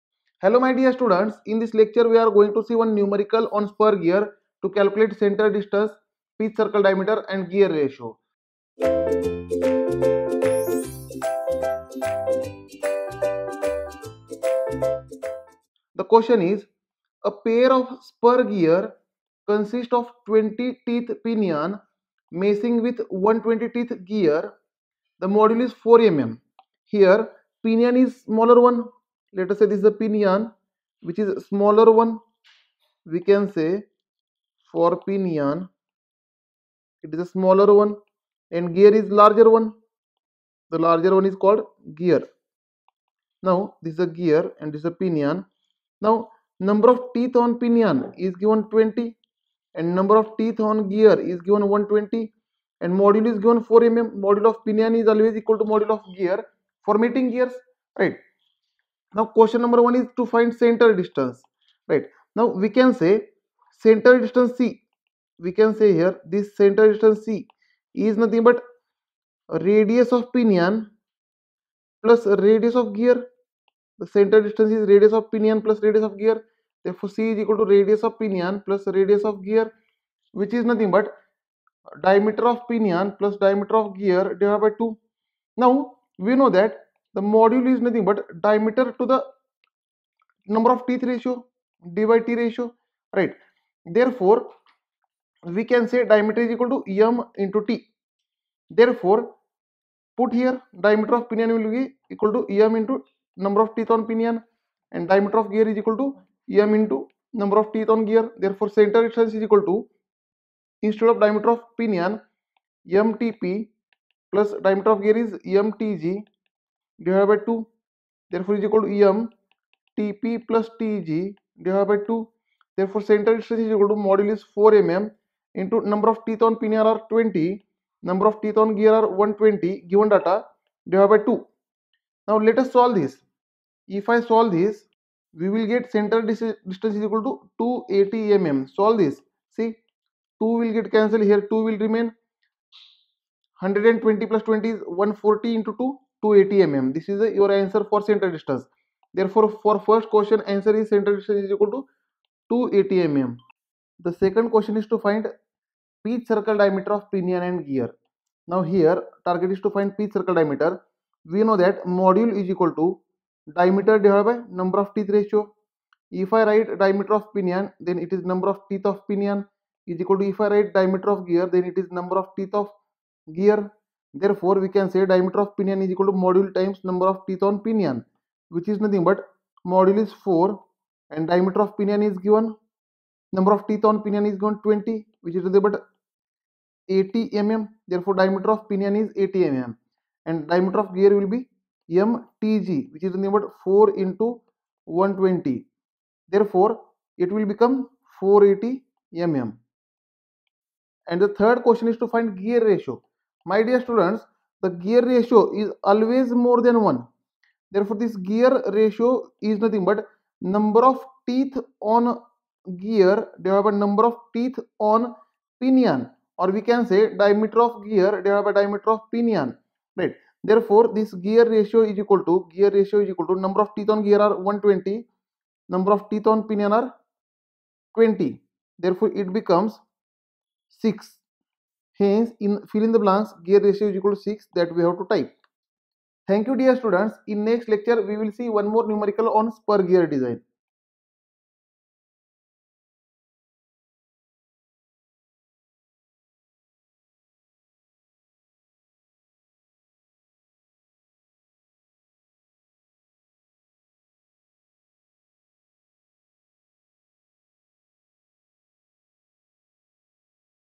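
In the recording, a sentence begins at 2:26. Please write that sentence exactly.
This is the, your answer for center distance.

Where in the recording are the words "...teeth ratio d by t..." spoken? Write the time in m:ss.
1:30.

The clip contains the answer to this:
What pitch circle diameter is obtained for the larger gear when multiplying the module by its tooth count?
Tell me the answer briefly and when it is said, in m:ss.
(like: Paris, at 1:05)
480 mm, at 3:18.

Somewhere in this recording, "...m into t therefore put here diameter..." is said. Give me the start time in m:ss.
1:37.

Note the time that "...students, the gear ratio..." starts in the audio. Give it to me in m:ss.
3:23.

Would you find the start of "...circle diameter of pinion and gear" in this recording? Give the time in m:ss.
2:36.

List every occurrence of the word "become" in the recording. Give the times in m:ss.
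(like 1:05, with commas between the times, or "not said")
3:17, 3:49.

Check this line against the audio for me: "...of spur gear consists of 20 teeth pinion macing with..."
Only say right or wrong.
right.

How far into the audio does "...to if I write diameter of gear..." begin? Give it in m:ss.
2:50.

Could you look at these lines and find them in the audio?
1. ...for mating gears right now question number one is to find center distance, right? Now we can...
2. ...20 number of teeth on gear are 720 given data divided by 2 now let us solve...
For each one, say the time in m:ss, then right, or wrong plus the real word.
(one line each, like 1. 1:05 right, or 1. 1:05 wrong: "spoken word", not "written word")
1. 0:56 right
2. 2:07 wrong: "120", not "720".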